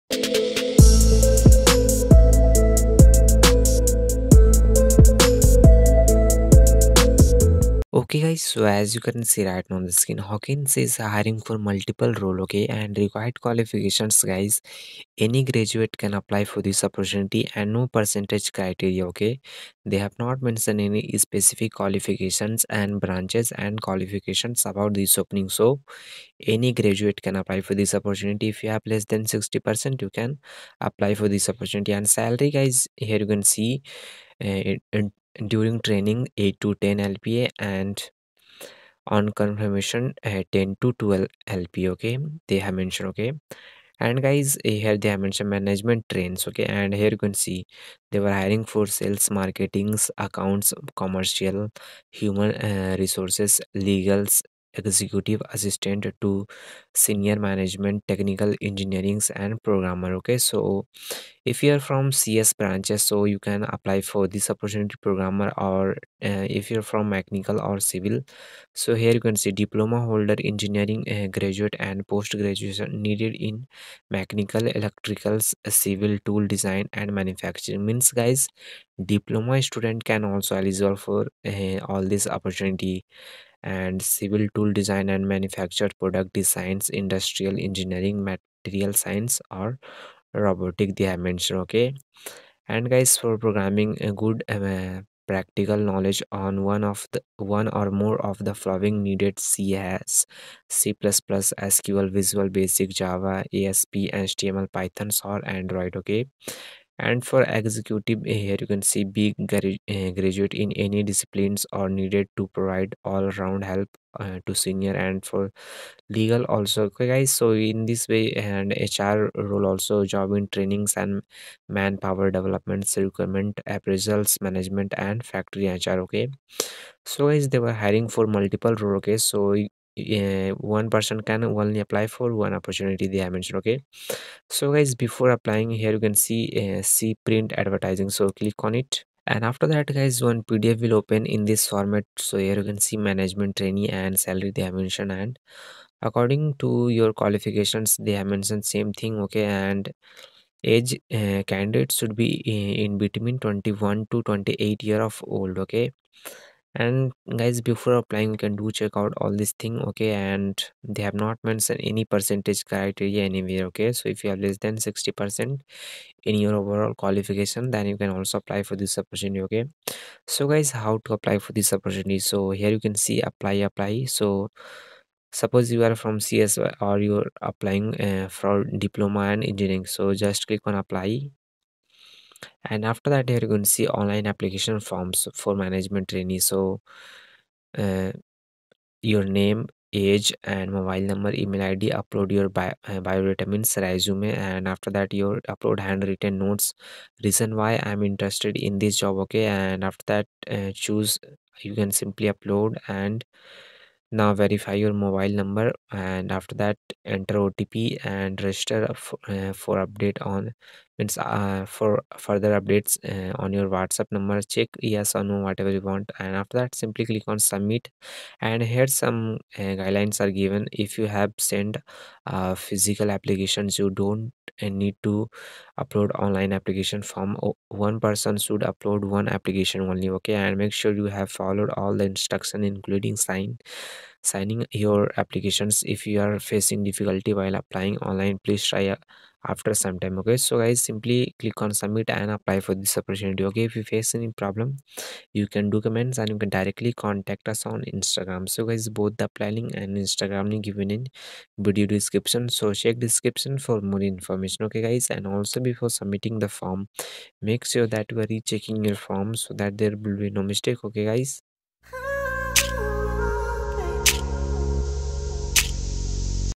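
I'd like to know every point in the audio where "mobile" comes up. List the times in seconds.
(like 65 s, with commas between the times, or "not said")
190 s, 204 s.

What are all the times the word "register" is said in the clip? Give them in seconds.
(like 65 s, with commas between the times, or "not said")
208 s.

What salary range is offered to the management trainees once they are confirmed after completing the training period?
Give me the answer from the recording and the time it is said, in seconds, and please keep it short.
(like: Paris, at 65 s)
10 to 12 LPA, at 40 s.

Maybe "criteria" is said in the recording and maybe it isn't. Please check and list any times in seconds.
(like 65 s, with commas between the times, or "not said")
18 s, 162 s.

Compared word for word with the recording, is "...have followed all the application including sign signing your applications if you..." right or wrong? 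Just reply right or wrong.
wrong.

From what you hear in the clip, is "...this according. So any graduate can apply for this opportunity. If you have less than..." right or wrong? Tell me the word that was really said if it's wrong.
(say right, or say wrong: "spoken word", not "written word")
wrong: "opening", not "according".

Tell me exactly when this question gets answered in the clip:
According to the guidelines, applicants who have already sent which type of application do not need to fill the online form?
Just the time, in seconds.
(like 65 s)
222 s.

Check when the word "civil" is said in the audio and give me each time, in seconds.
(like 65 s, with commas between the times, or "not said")
67 s, 75 s, 84 s.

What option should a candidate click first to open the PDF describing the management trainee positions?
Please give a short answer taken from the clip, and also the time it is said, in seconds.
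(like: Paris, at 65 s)
Print advertising, at 137 s.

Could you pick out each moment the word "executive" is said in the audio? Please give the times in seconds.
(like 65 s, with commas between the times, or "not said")
54 s, 107 s.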